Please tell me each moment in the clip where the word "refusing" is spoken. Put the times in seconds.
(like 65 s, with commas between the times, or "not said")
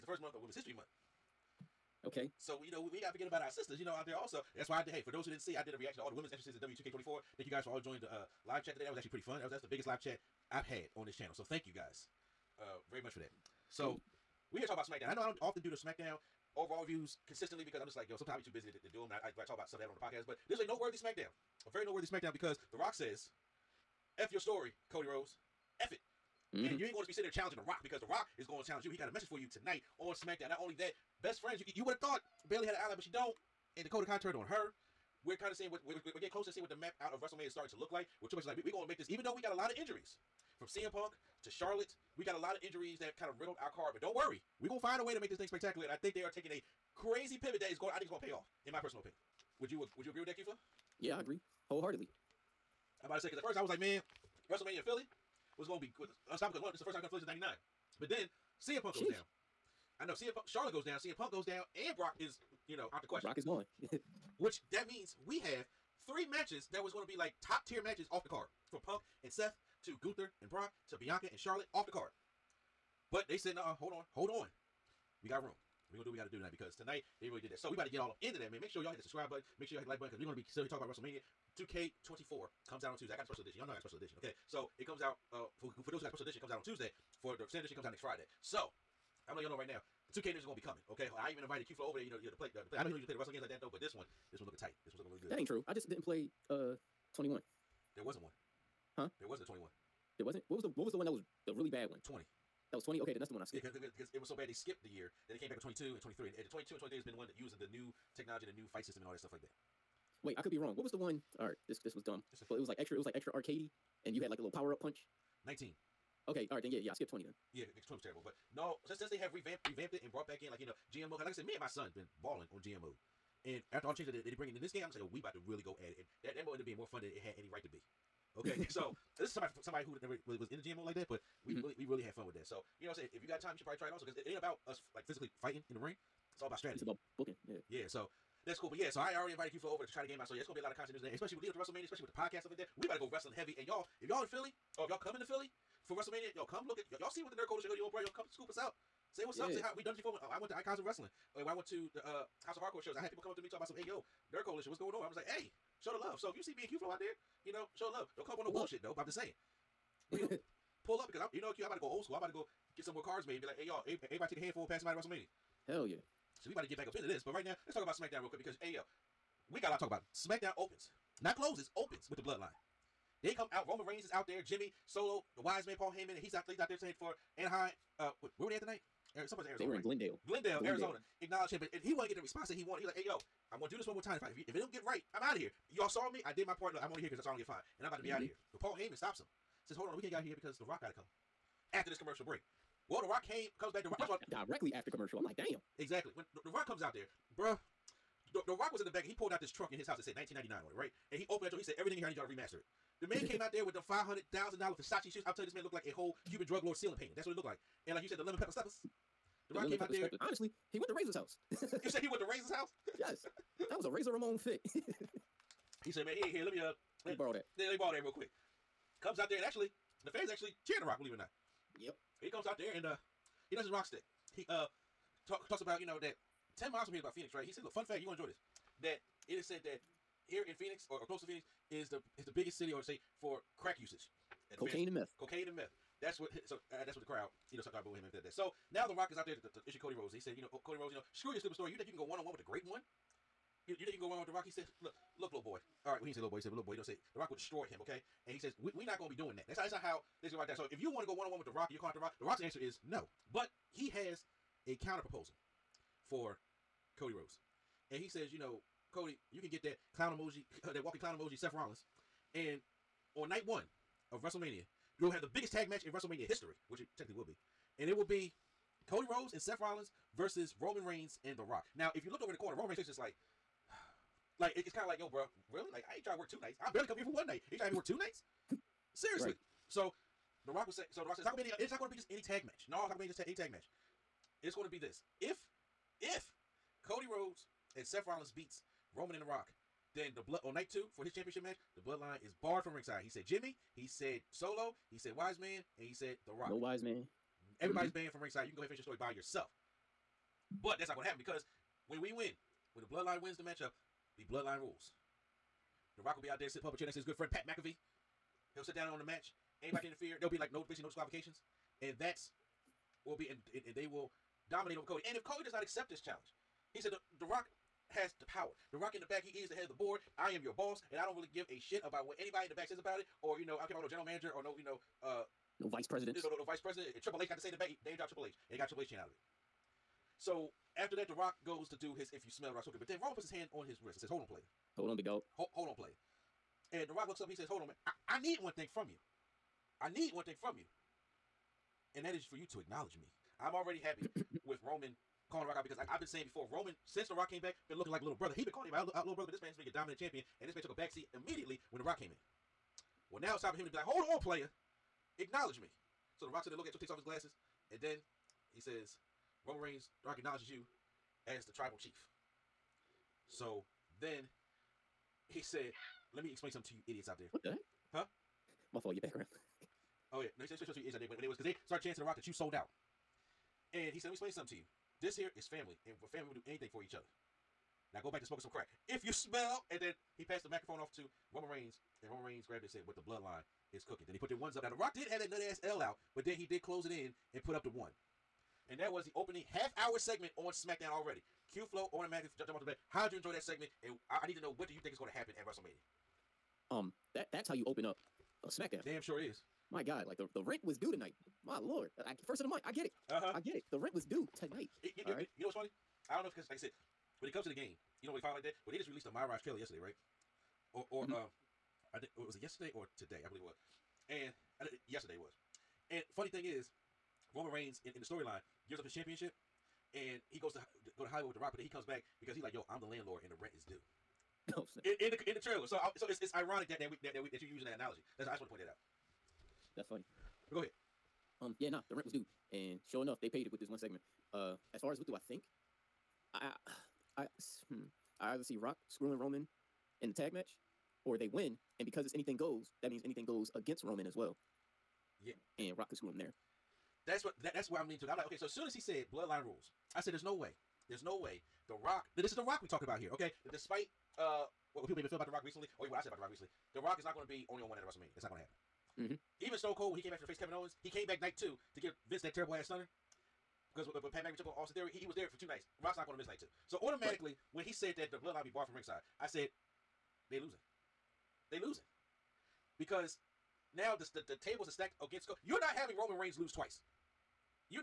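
not said.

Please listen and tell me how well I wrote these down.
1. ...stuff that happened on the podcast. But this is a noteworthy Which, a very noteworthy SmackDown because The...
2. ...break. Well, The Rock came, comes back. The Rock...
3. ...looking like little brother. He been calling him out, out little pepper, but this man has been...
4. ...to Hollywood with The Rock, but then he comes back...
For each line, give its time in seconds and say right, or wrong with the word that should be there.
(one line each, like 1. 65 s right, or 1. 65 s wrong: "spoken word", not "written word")
1. 19 s wrong: "SmackDown", not "Which"
2. 192 s right
3. 347 s wrong: "brother", not "pepper"
4. 421 s right.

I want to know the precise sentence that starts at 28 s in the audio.
He got a message for you tonight on SmackDown.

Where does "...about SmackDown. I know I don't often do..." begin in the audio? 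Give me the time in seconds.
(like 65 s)
14 s.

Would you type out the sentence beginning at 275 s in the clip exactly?
Like I ain't trying to work two nights.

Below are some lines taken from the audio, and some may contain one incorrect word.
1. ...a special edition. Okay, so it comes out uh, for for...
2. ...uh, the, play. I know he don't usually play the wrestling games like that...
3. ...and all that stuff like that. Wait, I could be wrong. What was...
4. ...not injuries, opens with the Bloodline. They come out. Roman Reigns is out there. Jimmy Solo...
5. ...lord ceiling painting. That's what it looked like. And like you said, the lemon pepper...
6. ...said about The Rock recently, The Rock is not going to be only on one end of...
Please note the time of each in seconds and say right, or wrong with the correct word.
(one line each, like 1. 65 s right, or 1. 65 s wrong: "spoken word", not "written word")
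1. 83 s right
2. 92 s right
3. 109 s right
4. 171 s wrong: "closes", not "injuries"
5. 206 s right
6. 456 s right.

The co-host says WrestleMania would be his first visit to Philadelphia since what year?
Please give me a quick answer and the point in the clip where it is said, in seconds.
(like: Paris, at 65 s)
1999, at 57 s.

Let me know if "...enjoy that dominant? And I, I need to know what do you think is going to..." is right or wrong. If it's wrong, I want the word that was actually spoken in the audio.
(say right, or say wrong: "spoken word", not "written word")
wrong: "segment", not "dominant".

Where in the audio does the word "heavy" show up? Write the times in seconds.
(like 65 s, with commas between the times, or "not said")
143 s.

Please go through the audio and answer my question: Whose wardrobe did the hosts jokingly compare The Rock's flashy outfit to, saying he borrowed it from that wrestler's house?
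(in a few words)
Razor Ramon.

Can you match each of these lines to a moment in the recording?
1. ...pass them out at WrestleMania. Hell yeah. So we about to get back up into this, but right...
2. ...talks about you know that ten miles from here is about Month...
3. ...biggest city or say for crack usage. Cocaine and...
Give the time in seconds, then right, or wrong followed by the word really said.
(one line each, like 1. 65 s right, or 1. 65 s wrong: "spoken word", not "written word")
1. 164 s right
2. 225 s wrong: "Phoenix", not "Month"
3. 232 s right.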